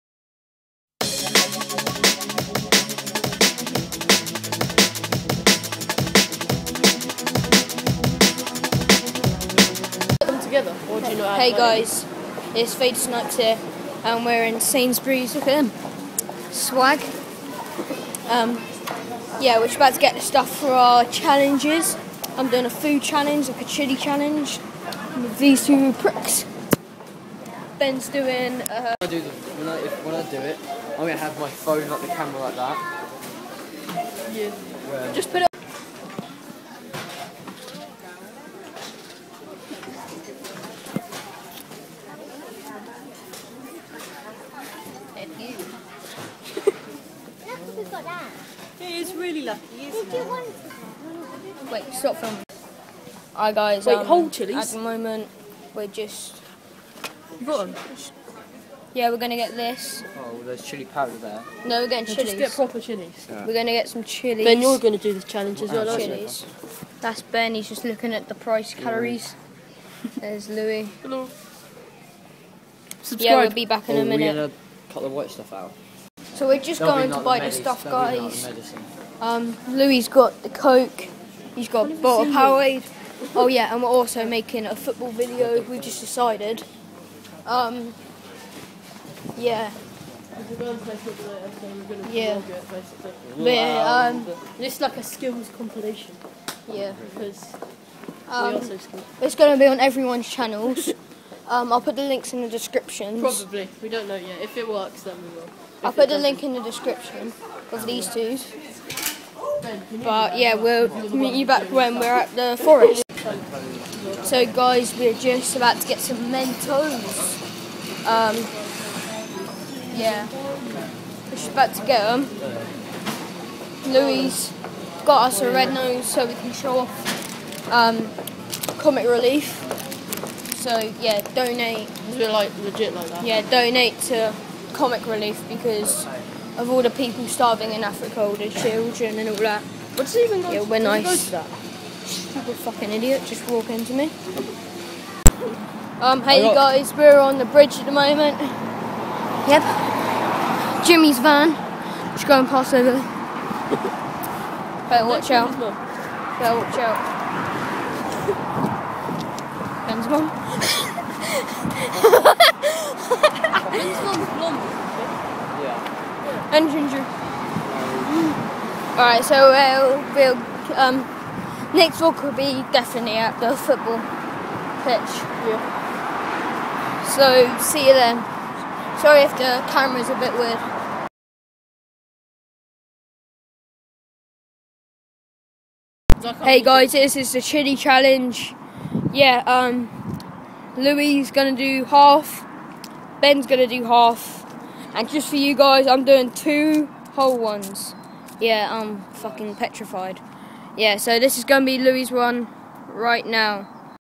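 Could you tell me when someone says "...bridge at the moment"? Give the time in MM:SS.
02:27.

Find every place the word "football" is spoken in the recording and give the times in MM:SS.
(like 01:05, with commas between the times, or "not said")
01:24, 02:53.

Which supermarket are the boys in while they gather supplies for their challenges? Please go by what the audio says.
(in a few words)
Sainsbury's.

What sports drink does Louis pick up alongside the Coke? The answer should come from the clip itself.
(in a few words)
Powerade.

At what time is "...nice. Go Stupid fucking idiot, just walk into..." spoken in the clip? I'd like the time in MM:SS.
02:20.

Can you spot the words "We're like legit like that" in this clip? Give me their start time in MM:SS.
02:12.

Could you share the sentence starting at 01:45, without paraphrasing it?
If I'll put the link in the description of these two.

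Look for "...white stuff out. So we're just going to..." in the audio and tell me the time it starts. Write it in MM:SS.
01:15.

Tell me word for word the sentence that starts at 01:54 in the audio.
So guys, we're just about to get some Mentos.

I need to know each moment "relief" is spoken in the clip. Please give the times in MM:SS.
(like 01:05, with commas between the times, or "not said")
02:09, 02:15.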